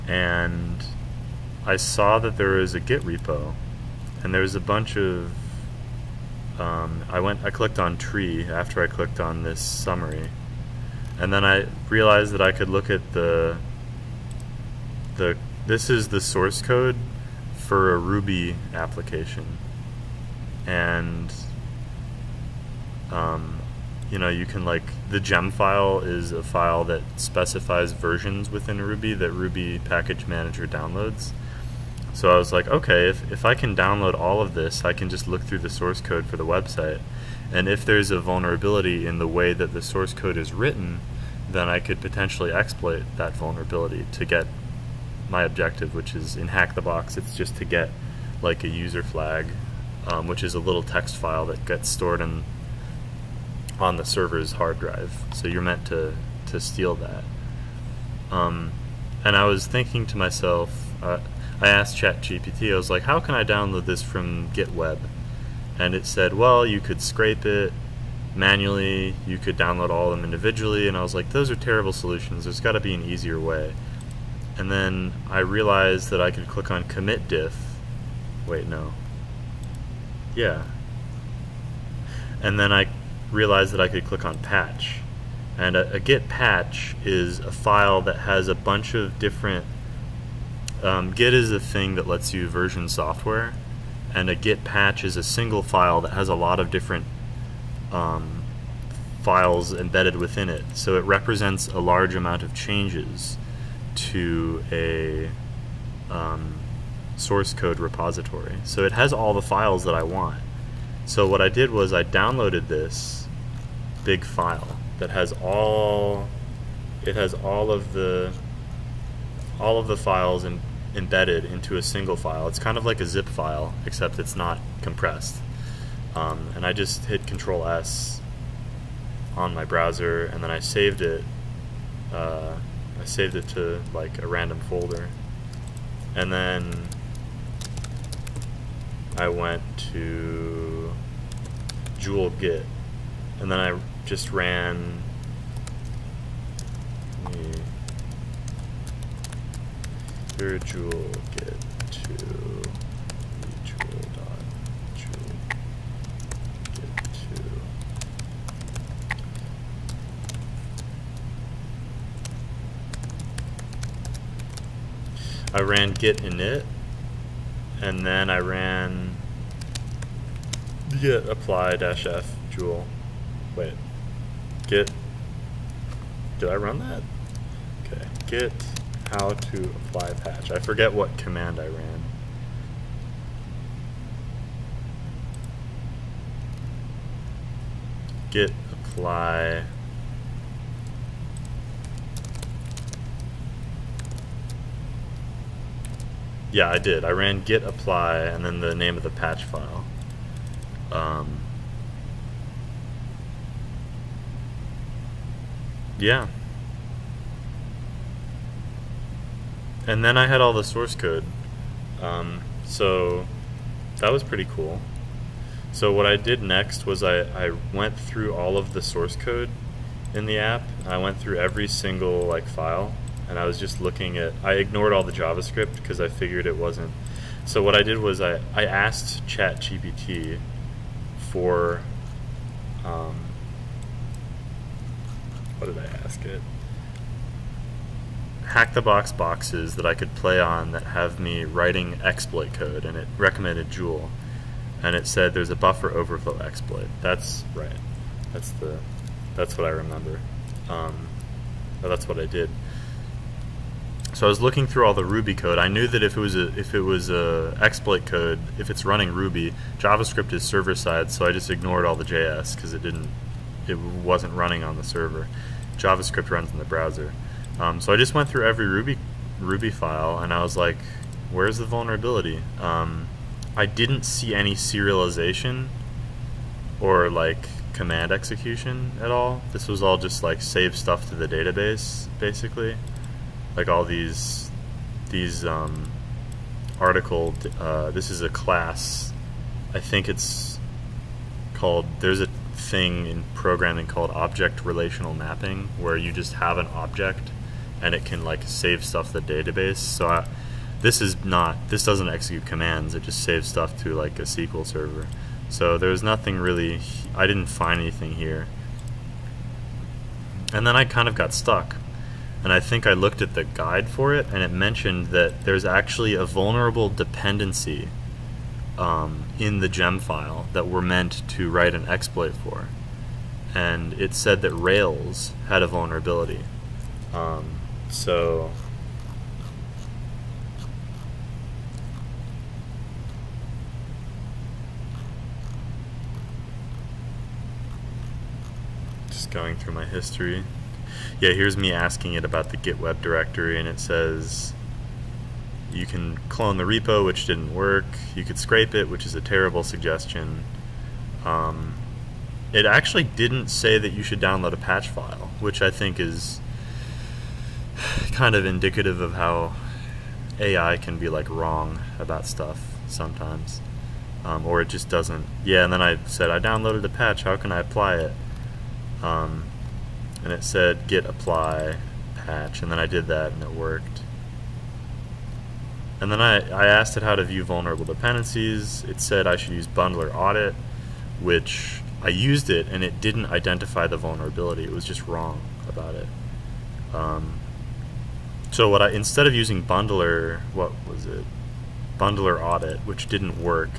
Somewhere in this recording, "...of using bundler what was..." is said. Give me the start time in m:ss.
6:29.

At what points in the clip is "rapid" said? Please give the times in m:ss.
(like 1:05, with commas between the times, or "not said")
not said.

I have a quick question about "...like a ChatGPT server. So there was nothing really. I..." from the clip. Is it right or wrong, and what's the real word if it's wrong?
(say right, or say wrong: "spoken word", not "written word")
wrong: "SQL", not "ChatGPT".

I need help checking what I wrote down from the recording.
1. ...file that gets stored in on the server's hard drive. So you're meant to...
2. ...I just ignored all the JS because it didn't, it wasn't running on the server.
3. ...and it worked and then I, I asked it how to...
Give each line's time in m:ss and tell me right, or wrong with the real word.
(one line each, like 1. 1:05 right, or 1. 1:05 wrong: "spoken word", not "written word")
1. 0:51 right
2. 4:21 right
3. 6:13 right.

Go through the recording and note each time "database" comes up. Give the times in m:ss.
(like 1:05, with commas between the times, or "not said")
4:41, 4:59.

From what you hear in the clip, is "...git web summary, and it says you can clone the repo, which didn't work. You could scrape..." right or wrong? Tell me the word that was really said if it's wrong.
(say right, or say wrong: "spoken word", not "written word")
wrong: "directory", not "summary".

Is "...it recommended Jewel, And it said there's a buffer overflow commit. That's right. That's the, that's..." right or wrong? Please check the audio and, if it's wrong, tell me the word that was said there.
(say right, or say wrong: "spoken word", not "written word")
wrong: "exploit", not "commit".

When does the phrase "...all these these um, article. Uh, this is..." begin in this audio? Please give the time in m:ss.
4:43.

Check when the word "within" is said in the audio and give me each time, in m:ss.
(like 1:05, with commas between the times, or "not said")
0:28, 1:40.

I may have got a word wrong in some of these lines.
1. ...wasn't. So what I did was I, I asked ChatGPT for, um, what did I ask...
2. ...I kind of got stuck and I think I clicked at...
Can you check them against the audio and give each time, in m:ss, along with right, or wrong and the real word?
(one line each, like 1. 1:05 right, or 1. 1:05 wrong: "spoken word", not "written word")
1. 3:46 right
2. 5:10 wrong: "looked", not "clicked".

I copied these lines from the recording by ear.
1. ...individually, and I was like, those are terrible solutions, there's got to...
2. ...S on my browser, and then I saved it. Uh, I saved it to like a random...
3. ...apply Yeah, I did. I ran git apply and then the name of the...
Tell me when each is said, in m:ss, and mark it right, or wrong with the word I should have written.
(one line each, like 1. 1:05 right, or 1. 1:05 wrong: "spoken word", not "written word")
1. 1:10 right
2. 2:07 right
3. 3:08 right.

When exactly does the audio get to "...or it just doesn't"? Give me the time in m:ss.
6:04.